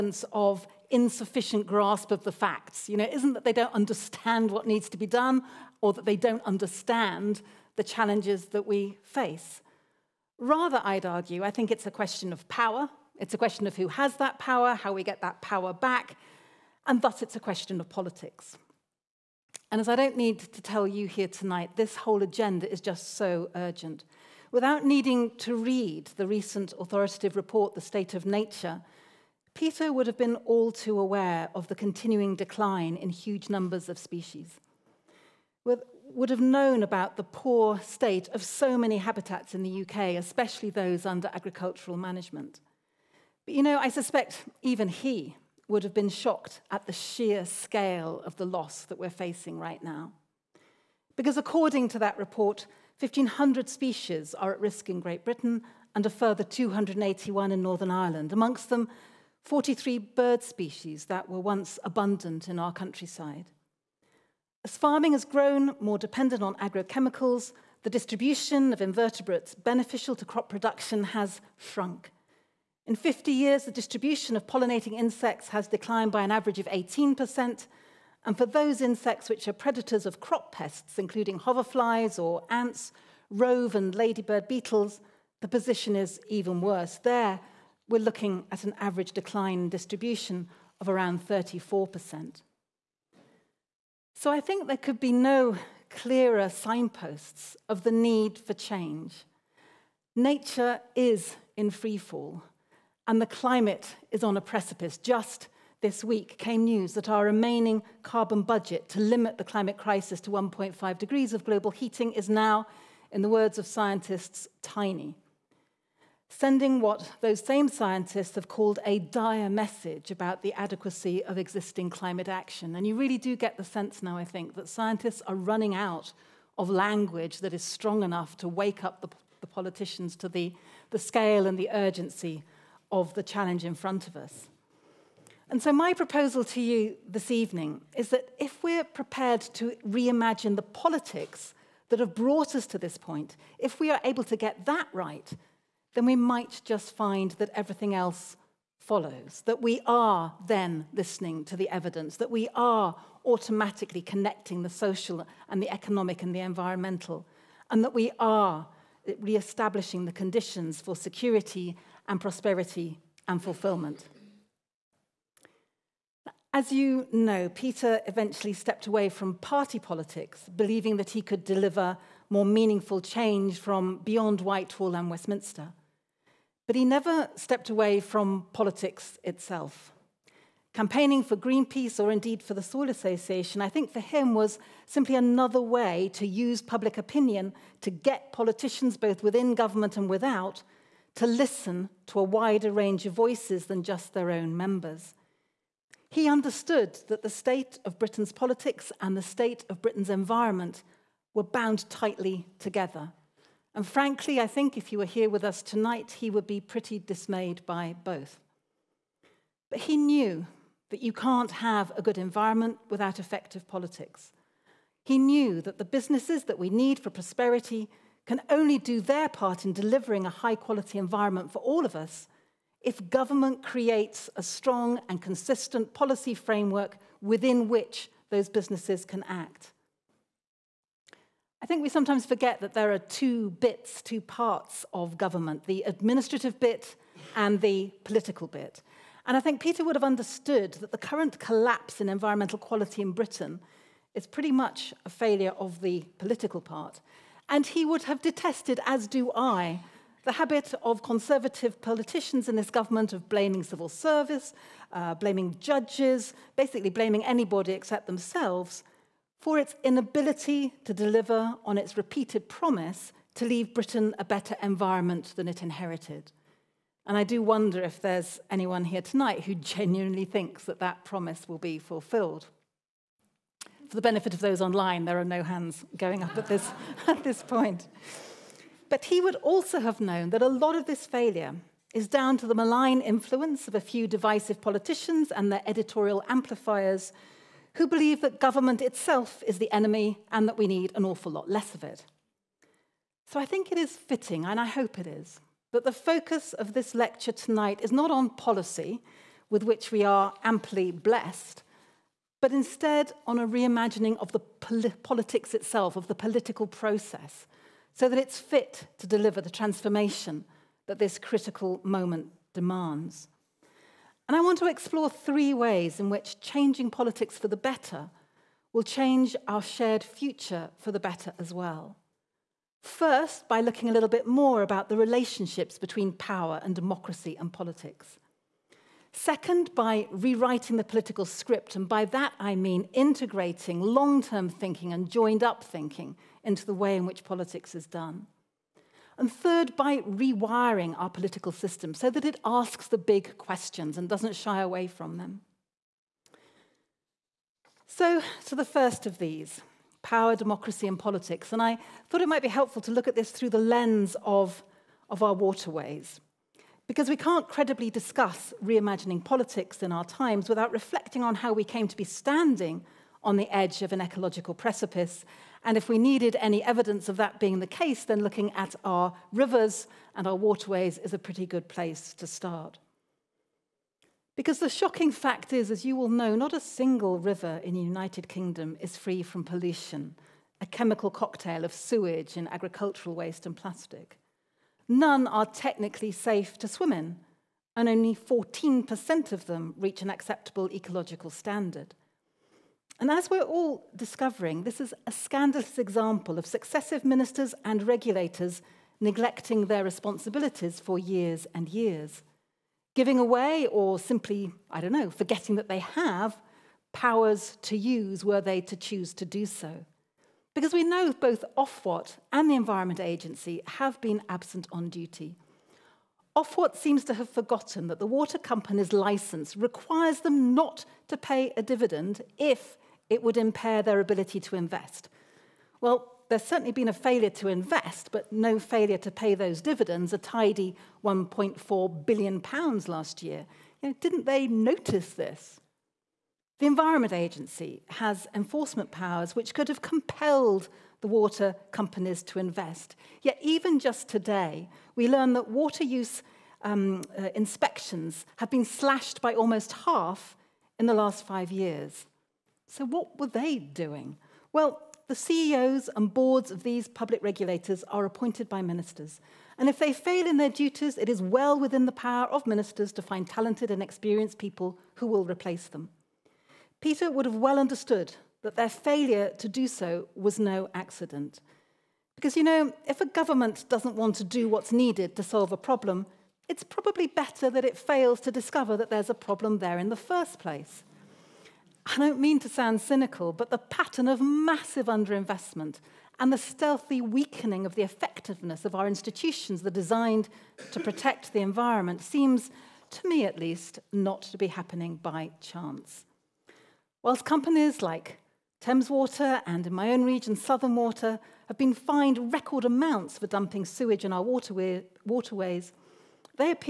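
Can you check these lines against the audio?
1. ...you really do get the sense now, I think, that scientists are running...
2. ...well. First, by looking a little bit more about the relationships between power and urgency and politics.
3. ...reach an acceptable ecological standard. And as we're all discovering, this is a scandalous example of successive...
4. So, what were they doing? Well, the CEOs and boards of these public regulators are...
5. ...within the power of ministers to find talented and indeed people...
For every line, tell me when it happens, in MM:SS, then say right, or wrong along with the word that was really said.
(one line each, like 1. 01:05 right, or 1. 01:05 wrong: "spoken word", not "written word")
1. 02:02 right
2. 05:21 wrong: "democracy", not "urgency"
3. 06:29 right
4. 07:32 right
5. 07:41 wrong: "experienced", not "indeed".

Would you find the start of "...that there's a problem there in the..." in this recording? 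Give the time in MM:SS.
07:58.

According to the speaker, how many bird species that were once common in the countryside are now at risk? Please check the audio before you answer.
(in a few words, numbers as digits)
43.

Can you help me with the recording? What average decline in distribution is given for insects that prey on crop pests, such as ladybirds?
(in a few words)
34%.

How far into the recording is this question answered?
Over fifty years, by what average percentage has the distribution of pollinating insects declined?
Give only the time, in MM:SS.
01:16.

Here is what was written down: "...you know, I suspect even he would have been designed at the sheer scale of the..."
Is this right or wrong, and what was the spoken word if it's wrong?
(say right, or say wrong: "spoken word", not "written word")
wrong: "shocked", not "designed".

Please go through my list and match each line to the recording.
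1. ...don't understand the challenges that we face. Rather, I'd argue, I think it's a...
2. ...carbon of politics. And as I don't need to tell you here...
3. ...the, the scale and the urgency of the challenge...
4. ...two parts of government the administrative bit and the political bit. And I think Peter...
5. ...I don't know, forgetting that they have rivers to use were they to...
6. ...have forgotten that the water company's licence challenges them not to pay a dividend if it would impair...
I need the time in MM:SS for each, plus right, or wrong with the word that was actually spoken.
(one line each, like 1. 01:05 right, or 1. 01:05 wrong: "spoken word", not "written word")
1. 00:06 right
2. 00:17 wrong: "question", not "carbon"
3. 02:10 right
4. 03:54 right
5. 06:44 wrong: "powers", not "rivers"
6. 06:57 wrong: "requires", not "challenges".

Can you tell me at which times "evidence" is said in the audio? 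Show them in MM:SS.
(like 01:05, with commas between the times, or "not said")
02:31, 06:06.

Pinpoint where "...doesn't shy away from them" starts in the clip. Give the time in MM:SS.
05:44.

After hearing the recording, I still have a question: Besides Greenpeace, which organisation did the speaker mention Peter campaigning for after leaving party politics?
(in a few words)
Soil Association.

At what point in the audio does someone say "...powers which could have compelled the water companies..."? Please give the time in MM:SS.
07:18.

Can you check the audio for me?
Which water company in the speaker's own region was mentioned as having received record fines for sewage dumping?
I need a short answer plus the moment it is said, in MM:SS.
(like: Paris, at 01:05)
Southern Water, at 08:20.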